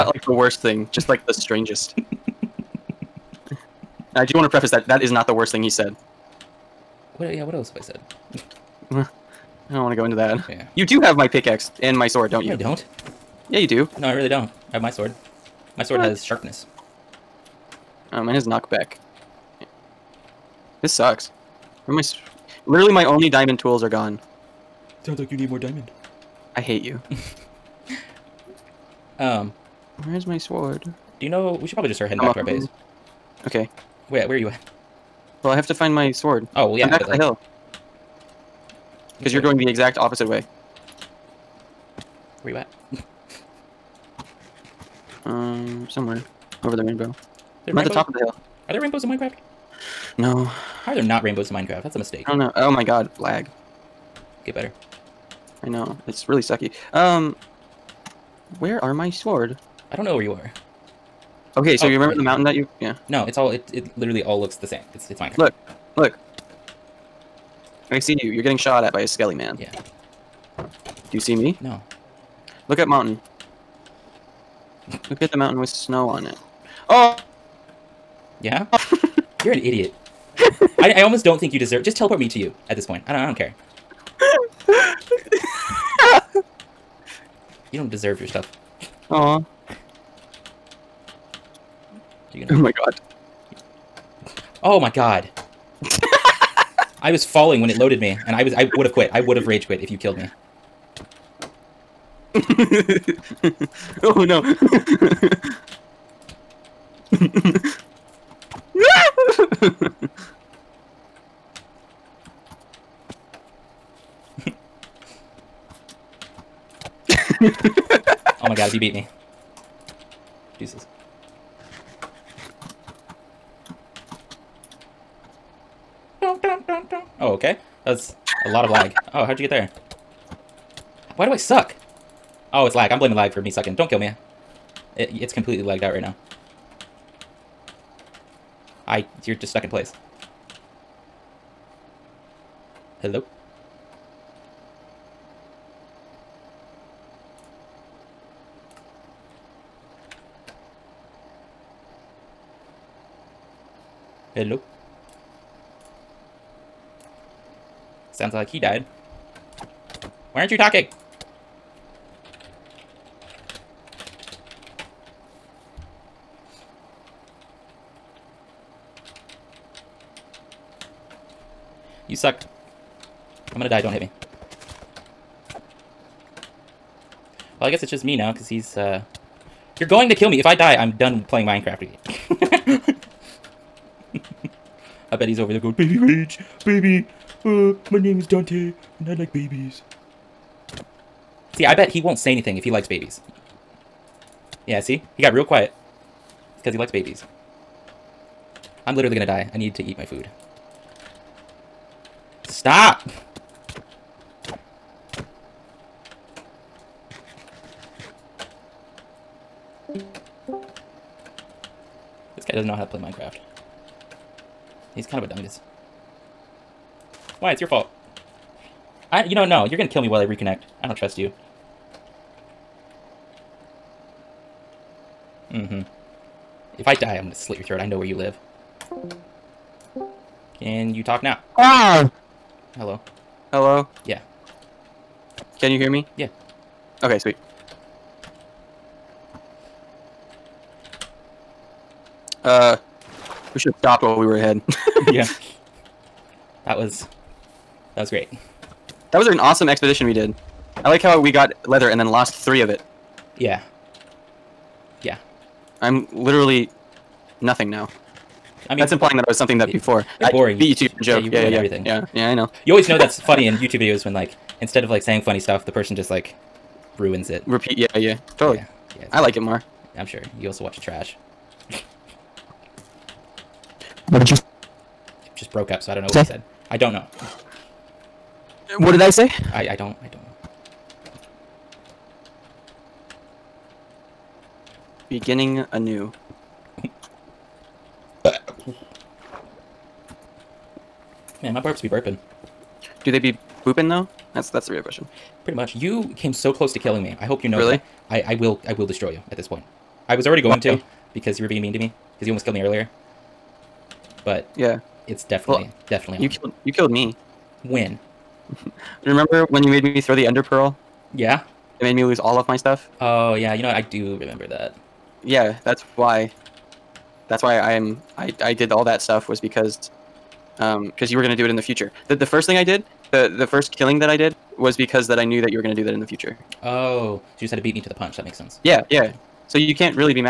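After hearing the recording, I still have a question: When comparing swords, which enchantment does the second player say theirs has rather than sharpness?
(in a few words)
Knockback.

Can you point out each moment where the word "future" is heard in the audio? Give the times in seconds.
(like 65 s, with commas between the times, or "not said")
321 s, 326 s.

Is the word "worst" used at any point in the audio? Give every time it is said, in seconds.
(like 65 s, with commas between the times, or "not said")
0 s, 5 s.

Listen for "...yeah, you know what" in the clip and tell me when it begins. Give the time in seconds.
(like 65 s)
313 s.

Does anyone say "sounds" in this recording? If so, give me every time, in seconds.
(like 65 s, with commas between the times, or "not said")
25 s, 158 s.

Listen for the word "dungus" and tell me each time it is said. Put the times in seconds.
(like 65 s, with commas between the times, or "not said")
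215 s.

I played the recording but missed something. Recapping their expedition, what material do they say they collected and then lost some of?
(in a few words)
Leather.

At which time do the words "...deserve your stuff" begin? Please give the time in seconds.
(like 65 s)
87 s.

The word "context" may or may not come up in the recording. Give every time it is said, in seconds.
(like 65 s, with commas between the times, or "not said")
not said.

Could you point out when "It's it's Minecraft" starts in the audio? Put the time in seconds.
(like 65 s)
64 s.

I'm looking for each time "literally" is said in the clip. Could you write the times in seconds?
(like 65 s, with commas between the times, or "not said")
22 s, 63 s, 198 s, 256 s.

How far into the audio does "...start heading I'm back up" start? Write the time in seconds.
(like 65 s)
31 s.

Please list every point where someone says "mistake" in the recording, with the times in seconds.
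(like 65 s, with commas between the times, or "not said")
51 s.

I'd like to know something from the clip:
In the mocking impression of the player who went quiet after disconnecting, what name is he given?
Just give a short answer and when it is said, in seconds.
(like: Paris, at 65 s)
Dante, at 188 s.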